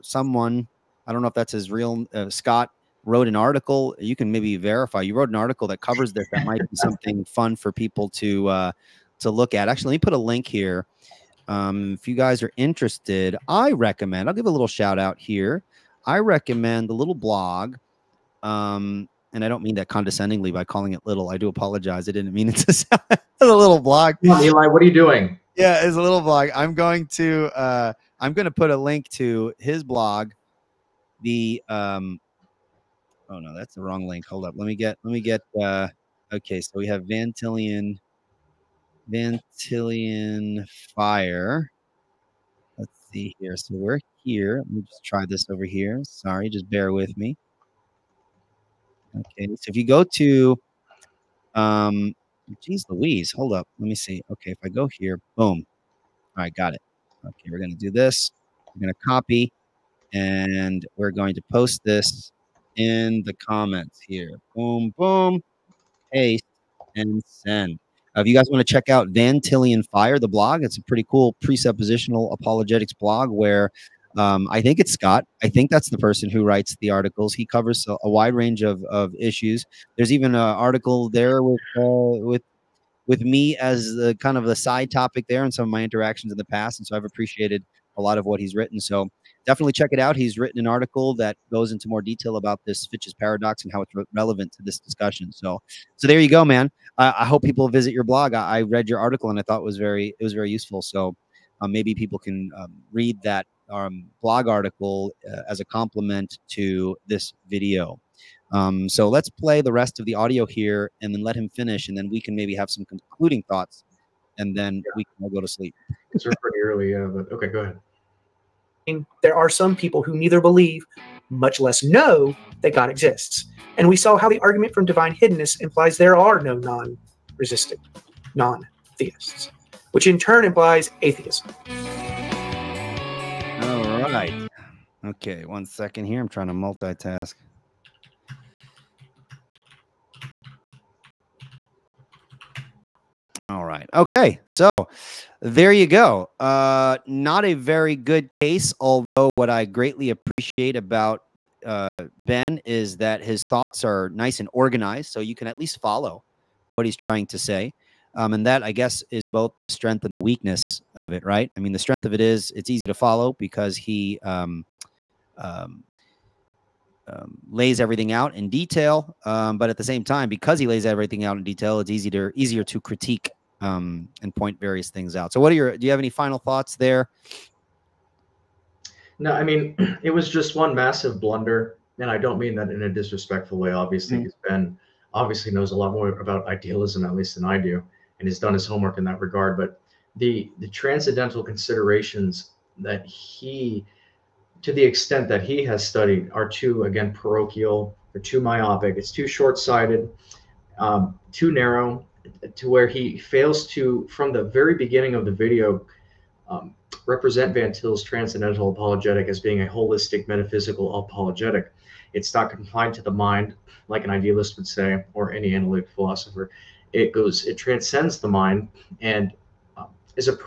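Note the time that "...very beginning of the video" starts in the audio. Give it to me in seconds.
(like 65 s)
204 s.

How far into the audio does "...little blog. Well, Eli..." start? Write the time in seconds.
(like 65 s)
23 s.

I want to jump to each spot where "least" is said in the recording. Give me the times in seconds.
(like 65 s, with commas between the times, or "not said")
155 s, 187 s.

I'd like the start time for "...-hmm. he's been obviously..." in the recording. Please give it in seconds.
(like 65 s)
184 s.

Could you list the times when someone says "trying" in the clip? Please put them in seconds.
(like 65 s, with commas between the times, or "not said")
136 s, 156 s.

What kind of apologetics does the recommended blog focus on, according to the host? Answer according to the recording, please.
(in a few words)
presuppositional apologetics.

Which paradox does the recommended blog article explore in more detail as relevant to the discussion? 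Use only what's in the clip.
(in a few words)
Fitch's paradox.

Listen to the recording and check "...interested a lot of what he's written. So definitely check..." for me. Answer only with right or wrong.
wrong.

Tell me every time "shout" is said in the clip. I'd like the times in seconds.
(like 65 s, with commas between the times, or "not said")
14 s.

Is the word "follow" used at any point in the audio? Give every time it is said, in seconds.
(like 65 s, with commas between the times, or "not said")
155 s, 162 s.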